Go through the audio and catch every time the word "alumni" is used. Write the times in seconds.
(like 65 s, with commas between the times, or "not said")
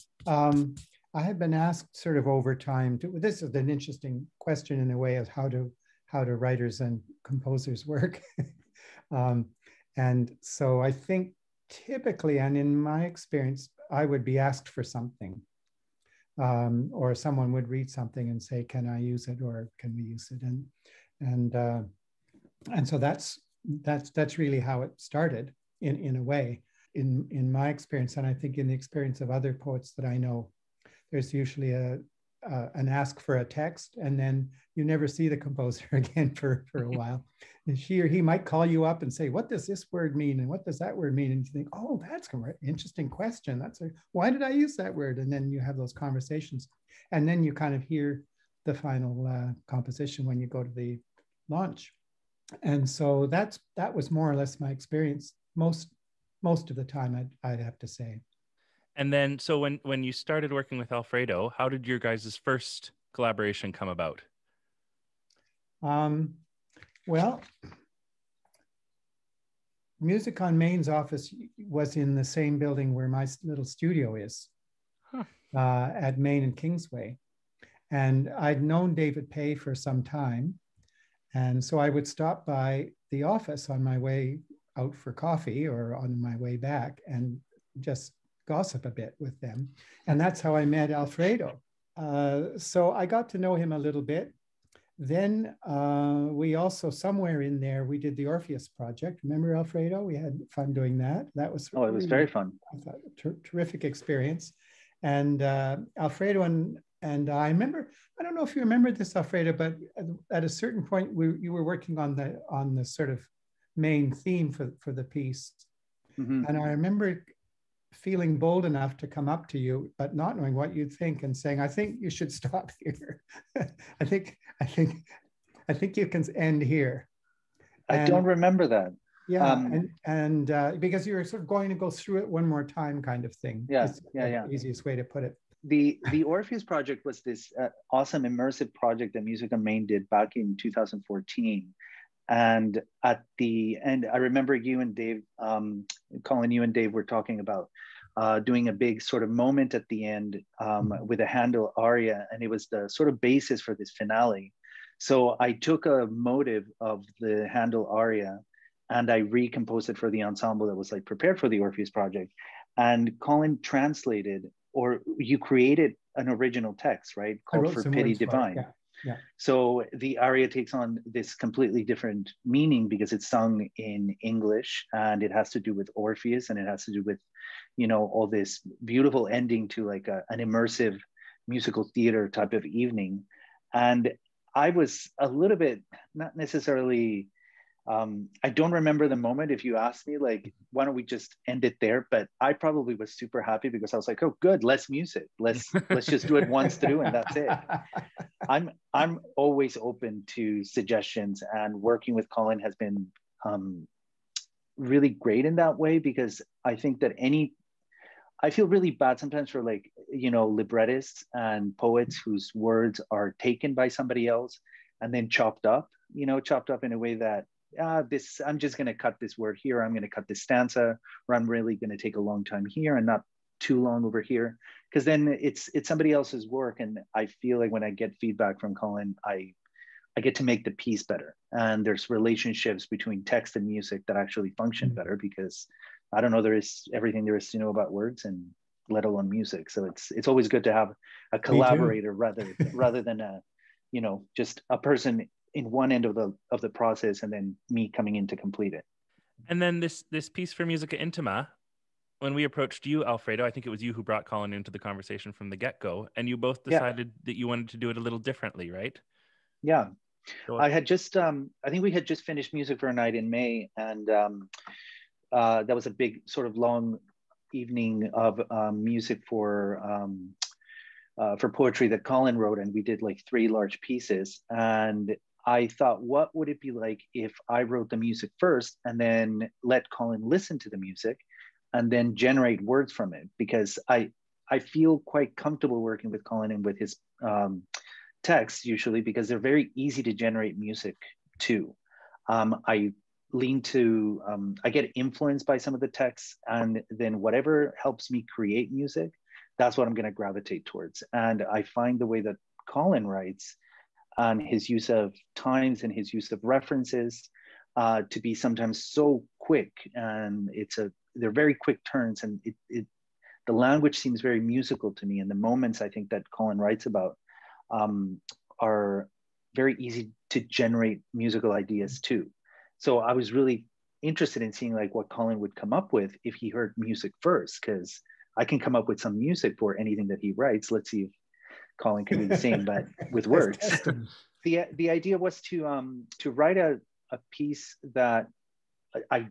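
not said.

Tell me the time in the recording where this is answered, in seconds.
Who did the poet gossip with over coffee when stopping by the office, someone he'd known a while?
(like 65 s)
78 s.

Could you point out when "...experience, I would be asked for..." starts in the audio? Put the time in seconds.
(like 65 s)
13 s.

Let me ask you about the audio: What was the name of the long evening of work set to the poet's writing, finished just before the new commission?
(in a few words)
Music for a Night in May.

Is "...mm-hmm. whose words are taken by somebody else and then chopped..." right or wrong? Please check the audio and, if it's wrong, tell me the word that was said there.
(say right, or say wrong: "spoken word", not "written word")
right.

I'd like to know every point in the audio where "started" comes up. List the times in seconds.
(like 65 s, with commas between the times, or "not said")
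25 s, 60 s.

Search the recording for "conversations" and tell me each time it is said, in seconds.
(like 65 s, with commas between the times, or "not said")
45 s, 254 s.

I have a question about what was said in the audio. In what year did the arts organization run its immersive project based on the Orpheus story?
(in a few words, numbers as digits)
2014.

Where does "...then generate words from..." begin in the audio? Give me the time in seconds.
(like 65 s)
281 s.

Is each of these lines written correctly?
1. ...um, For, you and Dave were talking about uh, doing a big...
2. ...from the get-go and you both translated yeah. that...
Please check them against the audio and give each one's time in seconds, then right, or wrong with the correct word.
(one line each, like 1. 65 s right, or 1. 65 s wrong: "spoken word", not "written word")
1. 145 s wrong: "Colin", not "For"
2. 255 s wrong: "decided", not "translated".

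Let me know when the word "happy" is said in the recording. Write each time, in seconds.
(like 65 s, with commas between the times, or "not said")
193 s.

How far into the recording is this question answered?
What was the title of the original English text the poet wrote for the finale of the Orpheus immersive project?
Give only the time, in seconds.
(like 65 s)
167 s.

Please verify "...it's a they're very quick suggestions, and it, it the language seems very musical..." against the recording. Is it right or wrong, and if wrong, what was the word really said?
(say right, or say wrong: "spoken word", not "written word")
wrong: "turns", not "suggestions".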